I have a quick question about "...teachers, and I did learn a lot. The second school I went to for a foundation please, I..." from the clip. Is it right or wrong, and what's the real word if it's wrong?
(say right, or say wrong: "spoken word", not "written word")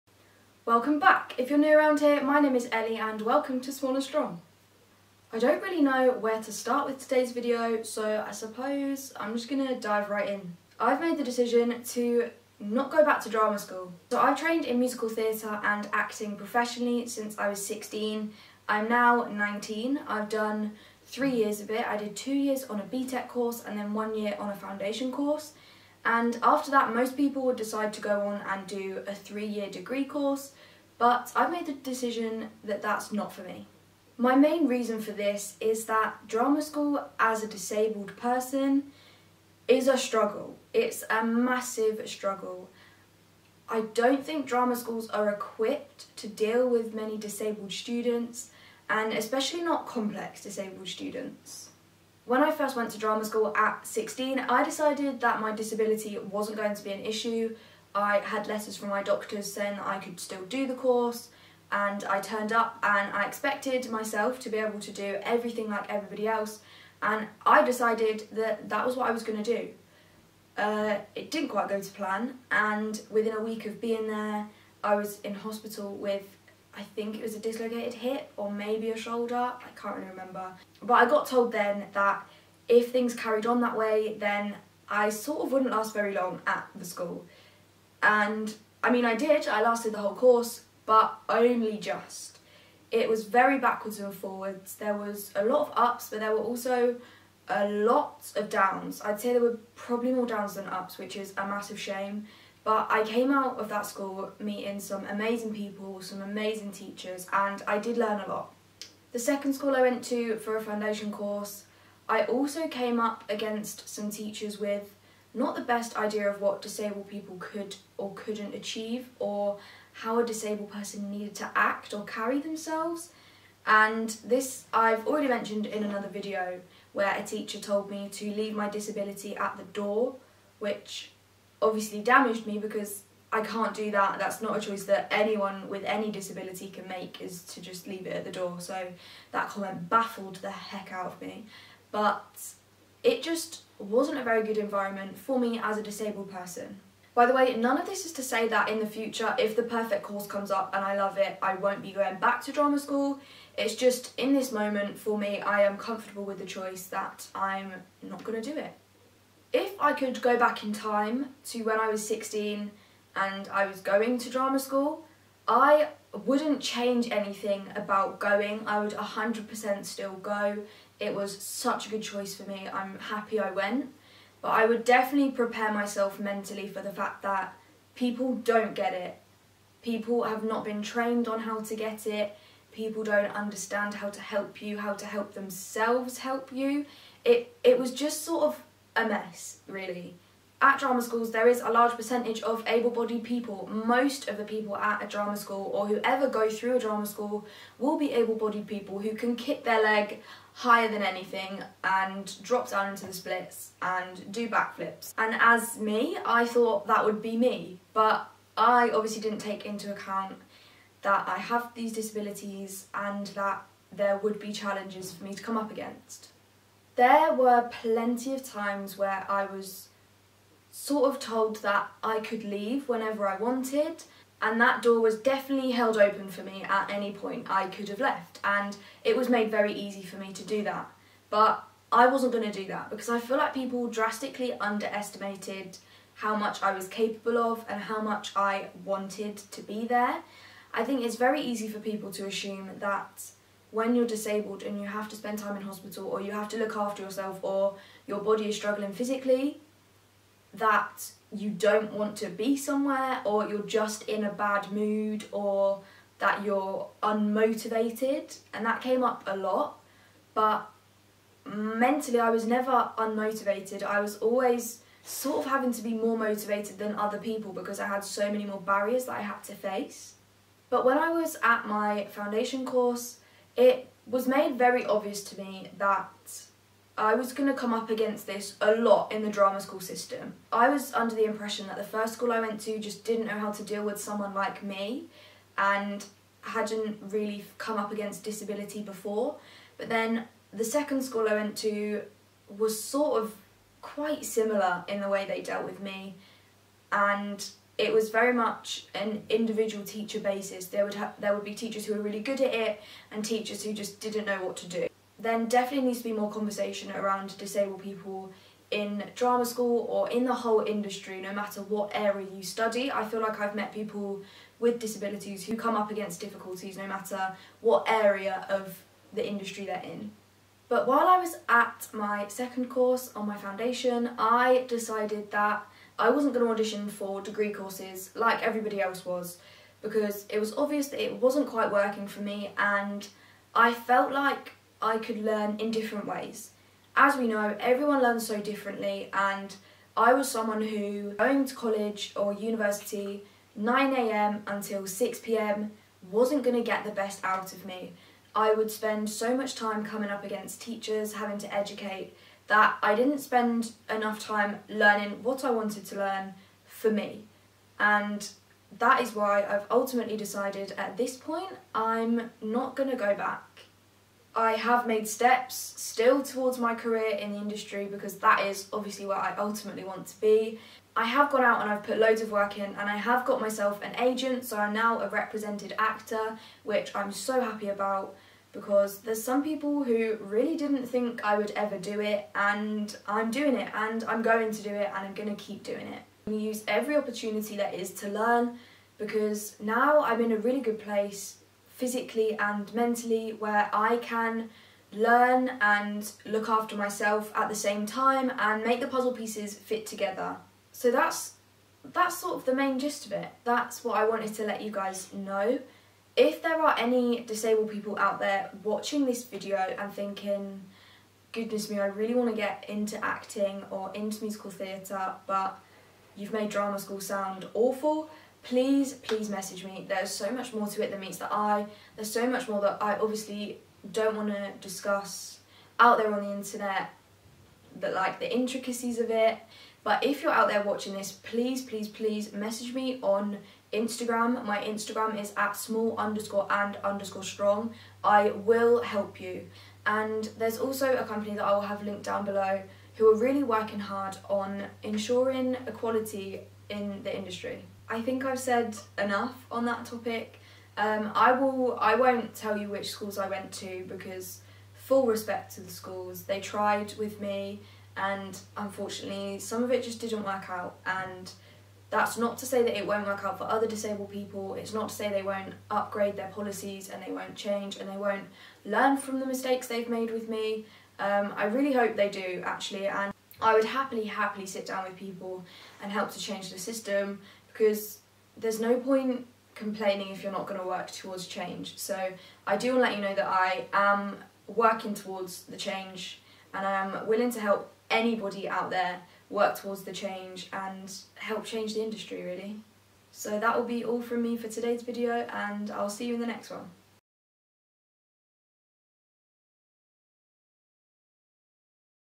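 wrong: "course", not "please".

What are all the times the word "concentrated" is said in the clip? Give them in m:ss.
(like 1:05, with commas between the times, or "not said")
not said.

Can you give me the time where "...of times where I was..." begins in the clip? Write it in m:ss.
3:38.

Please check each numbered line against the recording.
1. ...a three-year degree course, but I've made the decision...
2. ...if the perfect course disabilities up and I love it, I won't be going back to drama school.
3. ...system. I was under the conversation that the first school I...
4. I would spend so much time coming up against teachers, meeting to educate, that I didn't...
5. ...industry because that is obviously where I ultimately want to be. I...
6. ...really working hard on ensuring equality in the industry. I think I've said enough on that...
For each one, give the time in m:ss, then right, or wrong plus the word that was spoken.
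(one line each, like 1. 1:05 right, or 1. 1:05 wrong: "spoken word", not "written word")
1. 0:29 right
2. 2:29 wrong: "comes", not "disabilities"
3. 4:39 wrong: "impression", not "conversation"
4. 5:48 wrong: "having", not "meeting"
5. 6:07 right
6. 7:23 right.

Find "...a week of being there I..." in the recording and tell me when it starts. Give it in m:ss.
1:13.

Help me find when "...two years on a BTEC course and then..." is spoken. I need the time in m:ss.
0:22.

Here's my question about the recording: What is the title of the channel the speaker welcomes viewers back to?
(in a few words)
Small and Strong.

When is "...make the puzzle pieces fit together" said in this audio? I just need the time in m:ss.
6:38.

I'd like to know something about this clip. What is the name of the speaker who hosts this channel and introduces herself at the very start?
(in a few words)
Ellie.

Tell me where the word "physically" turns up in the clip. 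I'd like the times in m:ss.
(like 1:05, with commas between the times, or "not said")
4:08, 6:31.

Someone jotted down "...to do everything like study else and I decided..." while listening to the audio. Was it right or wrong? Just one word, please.
wrong.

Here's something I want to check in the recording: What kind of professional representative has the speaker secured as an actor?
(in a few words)
an agent.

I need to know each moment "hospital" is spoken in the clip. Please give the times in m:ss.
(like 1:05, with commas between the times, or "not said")
1:15, 4:05.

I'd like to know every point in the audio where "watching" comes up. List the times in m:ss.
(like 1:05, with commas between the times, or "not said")
6:48, 7:10.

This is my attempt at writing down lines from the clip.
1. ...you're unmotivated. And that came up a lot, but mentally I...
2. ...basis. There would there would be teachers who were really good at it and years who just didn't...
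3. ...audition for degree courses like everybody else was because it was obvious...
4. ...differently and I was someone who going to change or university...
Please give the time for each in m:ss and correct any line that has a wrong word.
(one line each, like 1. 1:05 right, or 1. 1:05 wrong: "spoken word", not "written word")
1. 4:16 right
2. 5:00 wrong: "teachers", not "years"
3. 5:26 right
4. 5:38 wrong: "college", not "change".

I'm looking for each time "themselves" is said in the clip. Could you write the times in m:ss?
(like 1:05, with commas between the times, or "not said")
2:02, 3:05.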